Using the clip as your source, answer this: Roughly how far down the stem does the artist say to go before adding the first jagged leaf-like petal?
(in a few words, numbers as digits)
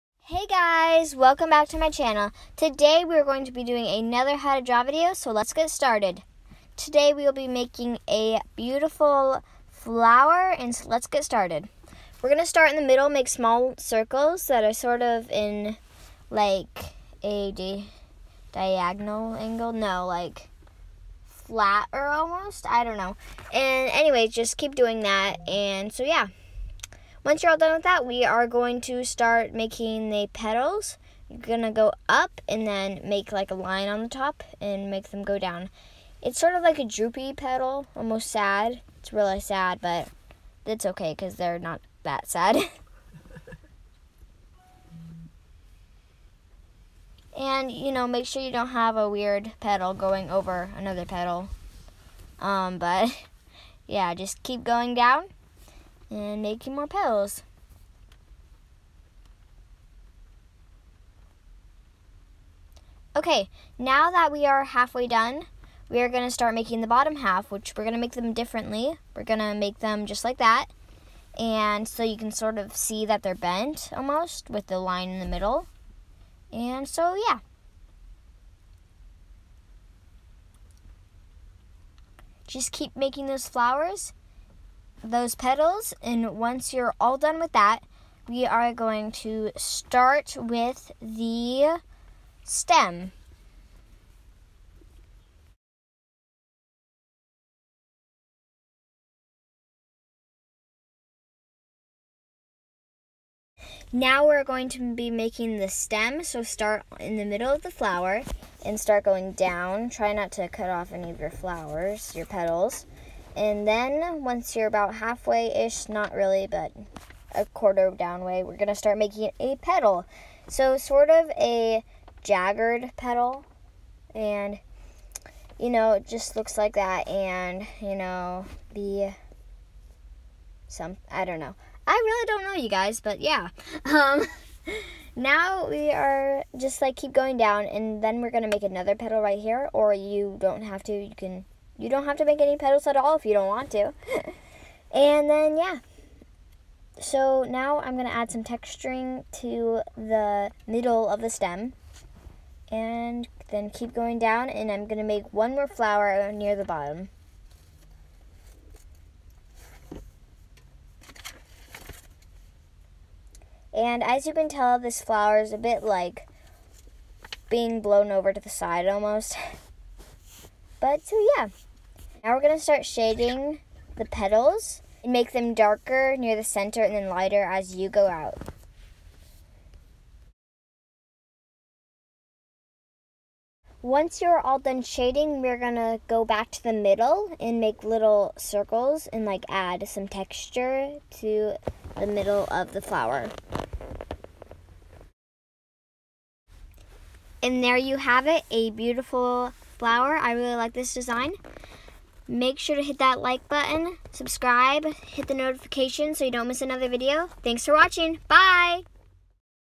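a quarter.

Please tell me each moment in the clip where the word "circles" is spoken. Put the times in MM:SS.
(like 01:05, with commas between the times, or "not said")
00:13, 03:08.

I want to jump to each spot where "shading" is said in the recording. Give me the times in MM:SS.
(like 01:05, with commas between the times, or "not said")
02:52, 03:04.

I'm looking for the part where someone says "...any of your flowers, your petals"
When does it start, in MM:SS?
01:50.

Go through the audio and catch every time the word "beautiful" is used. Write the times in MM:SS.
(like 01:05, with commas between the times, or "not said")
00:08, 03:18.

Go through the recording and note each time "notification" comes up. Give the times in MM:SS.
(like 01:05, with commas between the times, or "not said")
03:25.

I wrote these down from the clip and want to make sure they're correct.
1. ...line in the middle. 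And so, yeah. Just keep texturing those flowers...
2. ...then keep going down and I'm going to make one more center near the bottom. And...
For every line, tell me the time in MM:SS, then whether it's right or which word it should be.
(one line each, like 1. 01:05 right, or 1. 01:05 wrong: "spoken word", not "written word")
1. 01:14 wrong: "making", not "texturing"
2. 02:33 wrong: "flower", not "center".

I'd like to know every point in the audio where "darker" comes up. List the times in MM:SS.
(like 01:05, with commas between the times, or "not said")
02:55.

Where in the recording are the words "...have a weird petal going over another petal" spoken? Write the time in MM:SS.
00:48.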